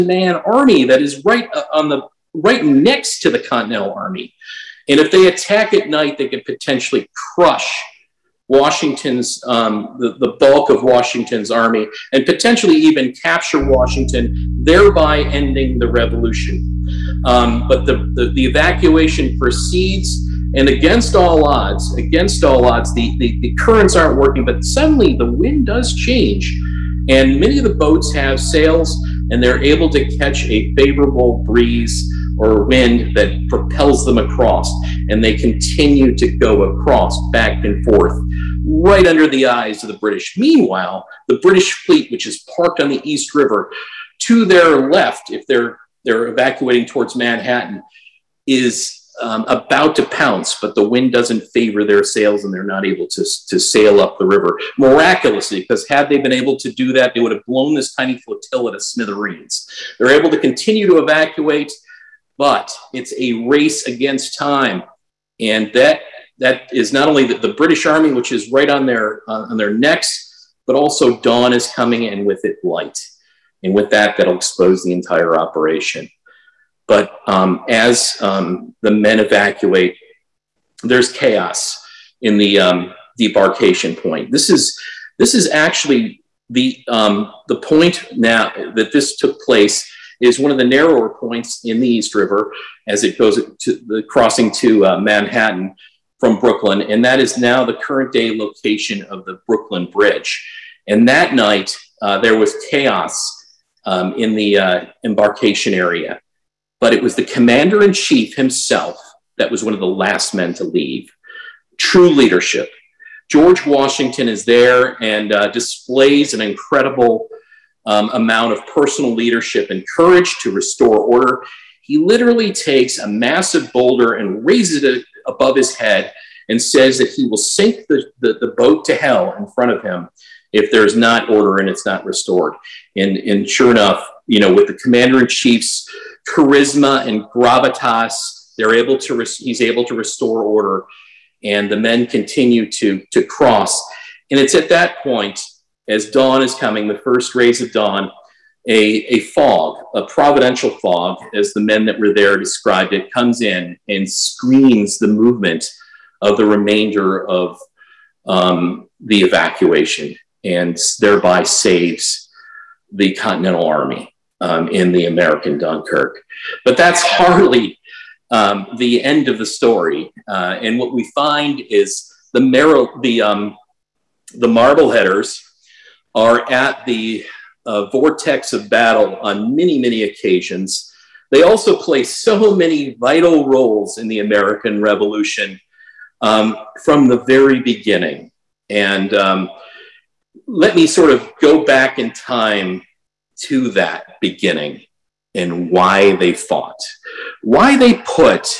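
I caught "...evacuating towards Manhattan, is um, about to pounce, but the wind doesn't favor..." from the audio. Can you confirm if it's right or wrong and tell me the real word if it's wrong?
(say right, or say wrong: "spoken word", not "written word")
right.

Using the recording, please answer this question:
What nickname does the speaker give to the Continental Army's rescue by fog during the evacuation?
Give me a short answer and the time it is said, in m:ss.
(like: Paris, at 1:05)
the American Dunkirk, at 2:45.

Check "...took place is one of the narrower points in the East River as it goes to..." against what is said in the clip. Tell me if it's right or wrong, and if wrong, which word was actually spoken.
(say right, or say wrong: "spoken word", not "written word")
right.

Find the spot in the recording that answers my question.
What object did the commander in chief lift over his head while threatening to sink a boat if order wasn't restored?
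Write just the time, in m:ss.
2:03.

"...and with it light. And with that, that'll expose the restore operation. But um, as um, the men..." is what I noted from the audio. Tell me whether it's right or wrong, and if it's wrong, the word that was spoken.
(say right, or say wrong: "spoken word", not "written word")
wrong: "entire", not "restore".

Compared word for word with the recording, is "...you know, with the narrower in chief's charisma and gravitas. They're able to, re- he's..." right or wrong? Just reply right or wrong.
wrong.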